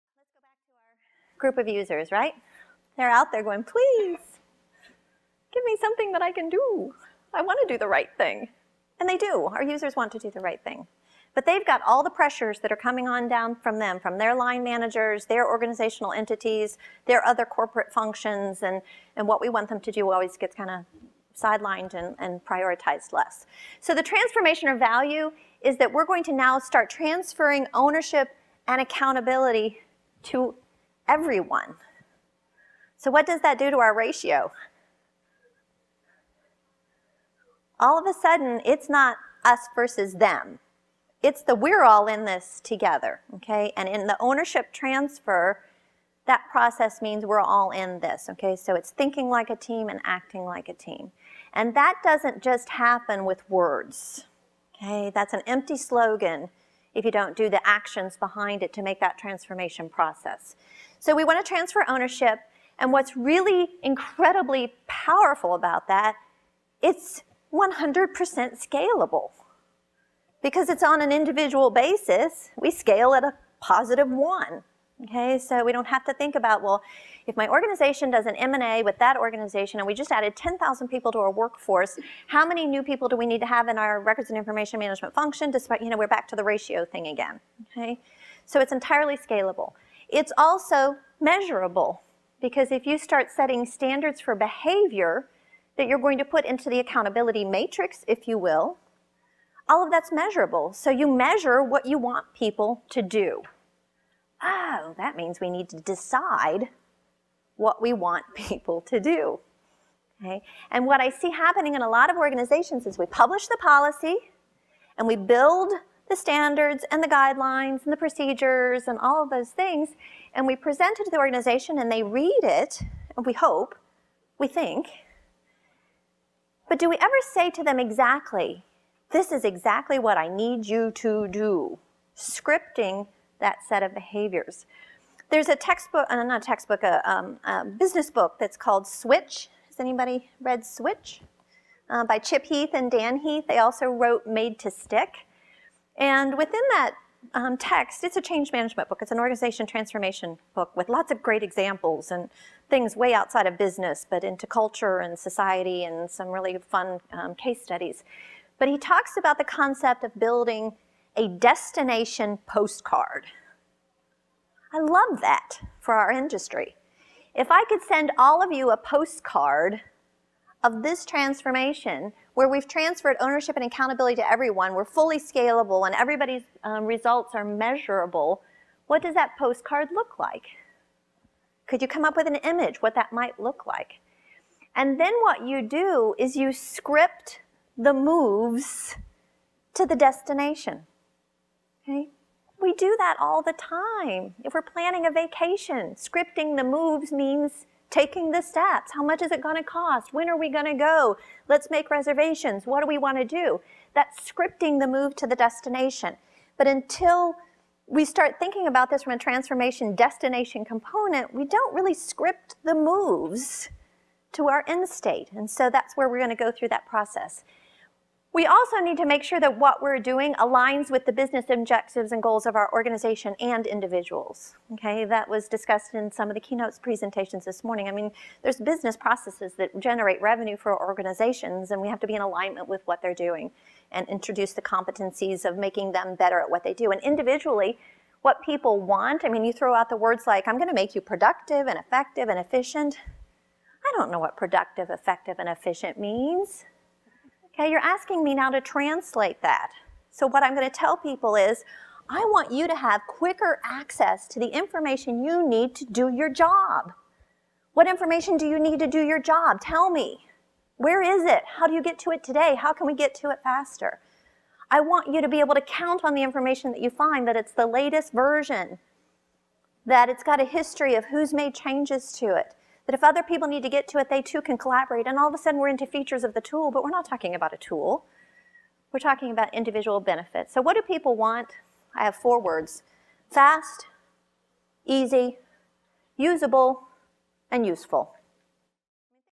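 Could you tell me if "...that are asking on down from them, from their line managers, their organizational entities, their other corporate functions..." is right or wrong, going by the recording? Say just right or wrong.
wrong.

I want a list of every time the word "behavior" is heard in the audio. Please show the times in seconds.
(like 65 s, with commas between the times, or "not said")
94 s, 133 s.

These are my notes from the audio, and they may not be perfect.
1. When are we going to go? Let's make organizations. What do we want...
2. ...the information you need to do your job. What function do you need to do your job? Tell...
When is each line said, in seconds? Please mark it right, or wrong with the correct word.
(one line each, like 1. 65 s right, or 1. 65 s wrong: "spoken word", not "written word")
1. 200 s wrong: "reservations", not "organizations"
2. 254 s wrong: "information", not "function".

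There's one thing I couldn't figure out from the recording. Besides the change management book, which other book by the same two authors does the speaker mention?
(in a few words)
Made to Stick.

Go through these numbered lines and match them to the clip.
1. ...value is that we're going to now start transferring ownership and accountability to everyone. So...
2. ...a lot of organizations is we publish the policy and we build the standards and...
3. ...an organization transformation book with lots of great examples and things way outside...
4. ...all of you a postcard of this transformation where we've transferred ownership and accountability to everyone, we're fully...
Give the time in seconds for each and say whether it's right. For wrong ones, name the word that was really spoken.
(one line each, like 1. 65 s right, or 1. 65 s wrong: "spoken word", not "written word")
1. 24 s right
2. 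111 s right
3. 149 s right
4. 168 s right.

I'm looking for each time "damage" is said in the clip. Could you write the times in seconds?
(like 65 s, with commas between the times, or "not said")
not said.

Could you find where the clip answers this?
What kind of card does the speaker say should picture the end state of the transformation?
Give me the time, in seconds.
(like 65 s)
161 s.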